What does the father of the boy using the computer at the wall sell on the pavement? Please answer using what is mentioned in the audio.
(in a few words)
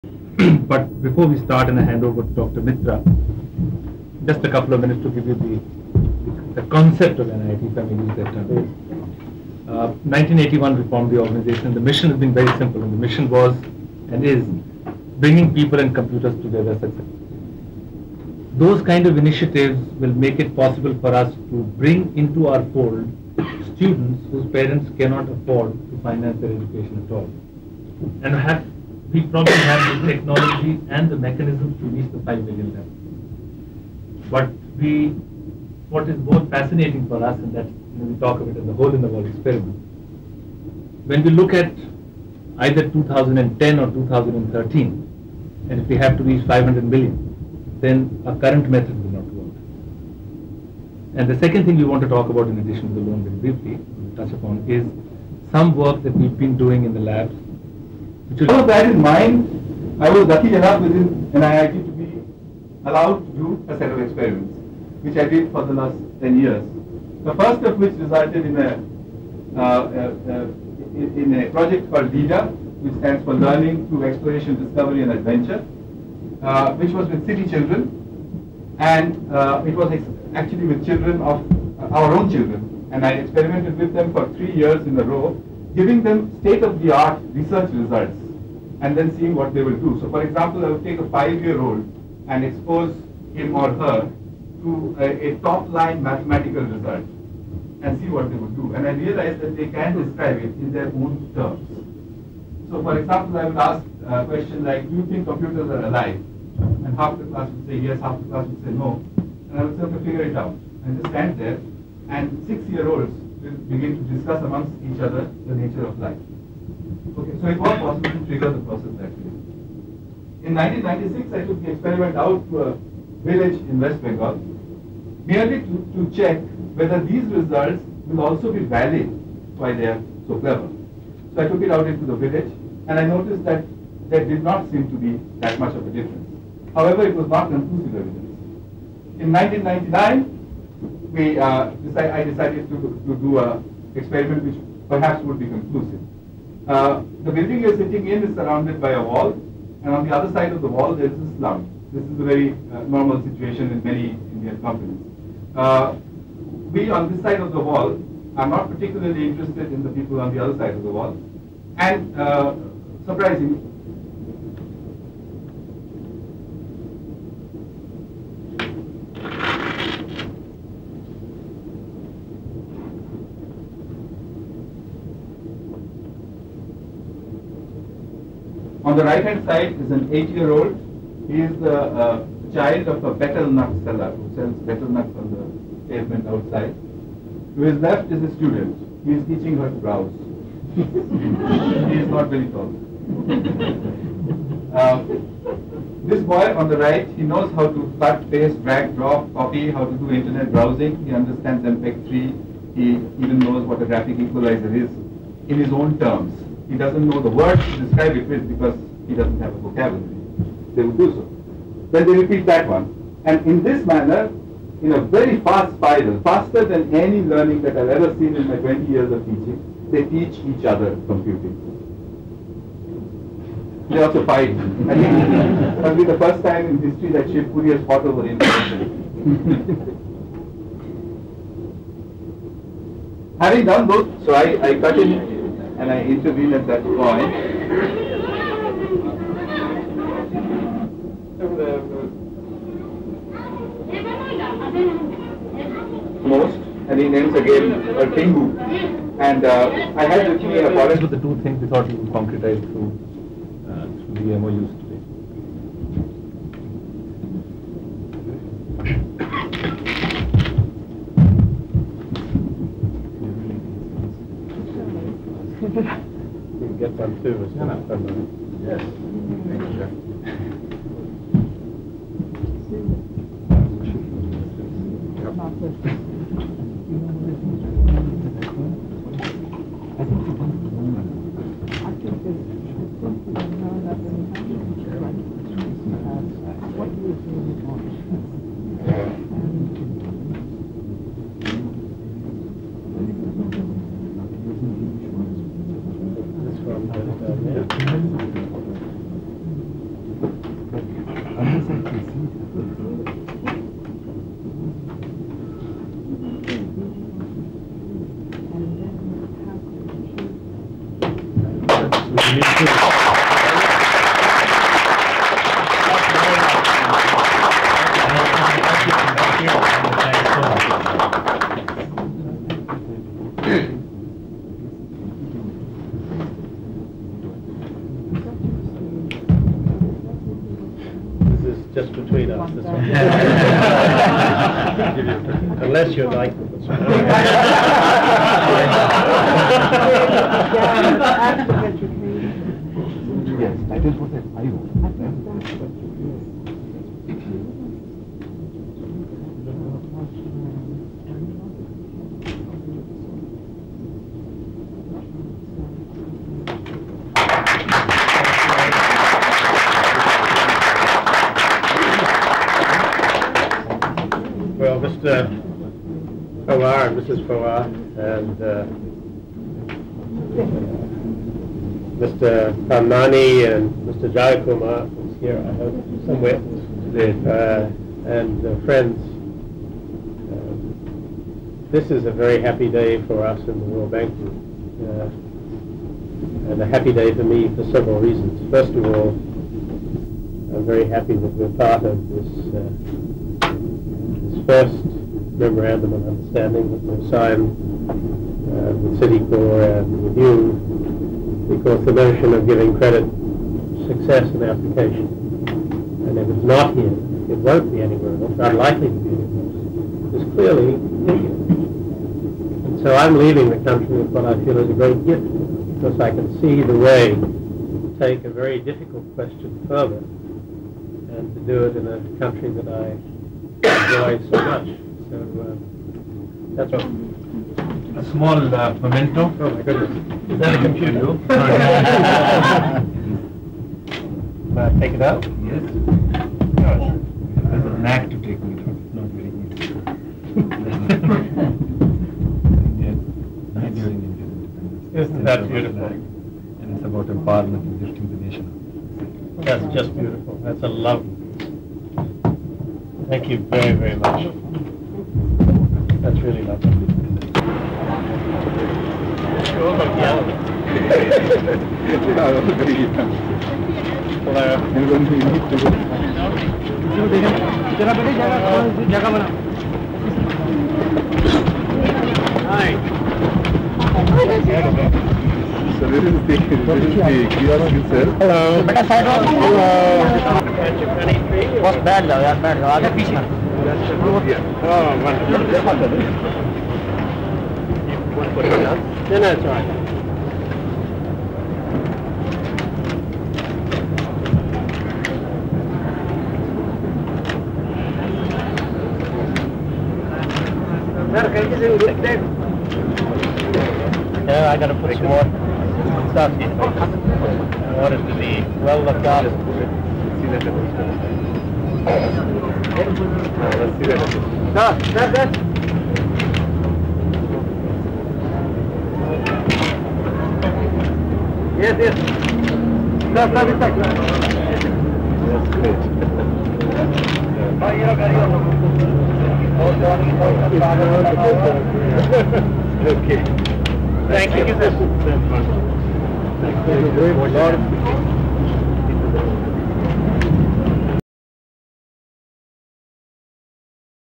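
Betel nuts.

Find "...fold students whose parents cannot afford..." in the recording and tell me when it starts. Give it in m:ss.
0:22.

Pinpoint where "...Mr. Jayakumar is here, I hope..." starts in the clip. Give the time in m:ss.
6:13.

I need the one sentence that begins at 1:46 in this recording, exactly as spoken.
And half the class would say yes, half the class would say no.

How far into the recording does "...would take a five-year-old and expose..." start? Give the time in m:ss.
1:30.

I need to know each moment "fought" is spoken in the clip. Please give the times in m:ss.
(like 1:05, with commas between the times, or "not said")
3:47.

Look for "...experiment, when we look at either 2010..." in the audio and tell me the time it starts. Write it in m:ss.
0:39.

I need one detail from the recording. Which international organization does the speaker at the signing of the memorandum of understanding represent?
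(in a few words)
World Bank Group.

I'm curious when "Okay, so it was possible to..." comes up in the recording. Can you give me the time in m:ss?
1:57.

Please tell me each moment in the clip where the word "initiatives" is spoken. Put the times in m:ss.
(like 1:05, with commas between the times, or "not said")
0:19.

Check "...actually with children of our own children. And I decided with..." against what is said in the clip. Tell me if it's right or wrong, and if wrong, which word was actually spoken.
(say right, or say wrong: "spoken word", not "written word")
wrong: "experimented", not "decided".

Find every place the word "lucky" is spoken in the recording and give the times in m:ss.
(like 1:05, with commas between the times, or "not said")
1:00.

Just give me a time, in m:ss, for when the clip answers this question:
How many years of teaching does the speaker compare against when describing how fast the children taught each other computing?
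3:38.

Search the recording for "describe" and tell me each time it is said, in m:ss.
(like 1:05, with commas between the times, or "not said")
1:40, 3:27.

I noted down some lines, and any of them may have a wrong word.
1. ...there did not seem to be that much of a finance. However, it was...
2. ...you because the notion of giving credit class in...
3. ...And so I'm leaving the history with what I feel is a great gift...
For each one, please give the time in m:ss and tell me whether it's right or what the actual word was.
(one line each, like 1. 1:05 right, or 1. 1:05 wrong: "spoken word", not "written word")
1. 2:14 wrong: "difference", not "finance"
2. 6:40 wrong: "success", not "class"
3. 6:52 wrong: "country", not "history".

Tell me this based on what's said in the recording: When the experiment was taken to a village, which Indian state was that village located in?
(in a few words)
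West Bengal.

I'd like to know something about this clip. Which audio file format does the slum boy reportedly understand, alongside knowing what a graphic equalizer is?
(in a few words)
MPEG 3.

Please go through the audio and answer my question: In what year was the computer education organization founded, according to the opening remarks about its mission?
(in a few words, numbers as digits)
1981.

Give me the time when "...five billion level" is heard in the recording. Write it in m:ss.
0:32.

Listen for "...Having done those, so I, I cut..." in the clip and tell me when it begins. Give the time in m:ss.
3:53.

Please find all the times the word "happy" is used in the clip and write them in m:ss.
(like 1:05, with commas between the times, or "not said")
6:22, 6:26, 6:30.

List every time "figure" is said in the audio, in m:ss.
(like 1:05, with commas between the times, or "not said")
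1:50.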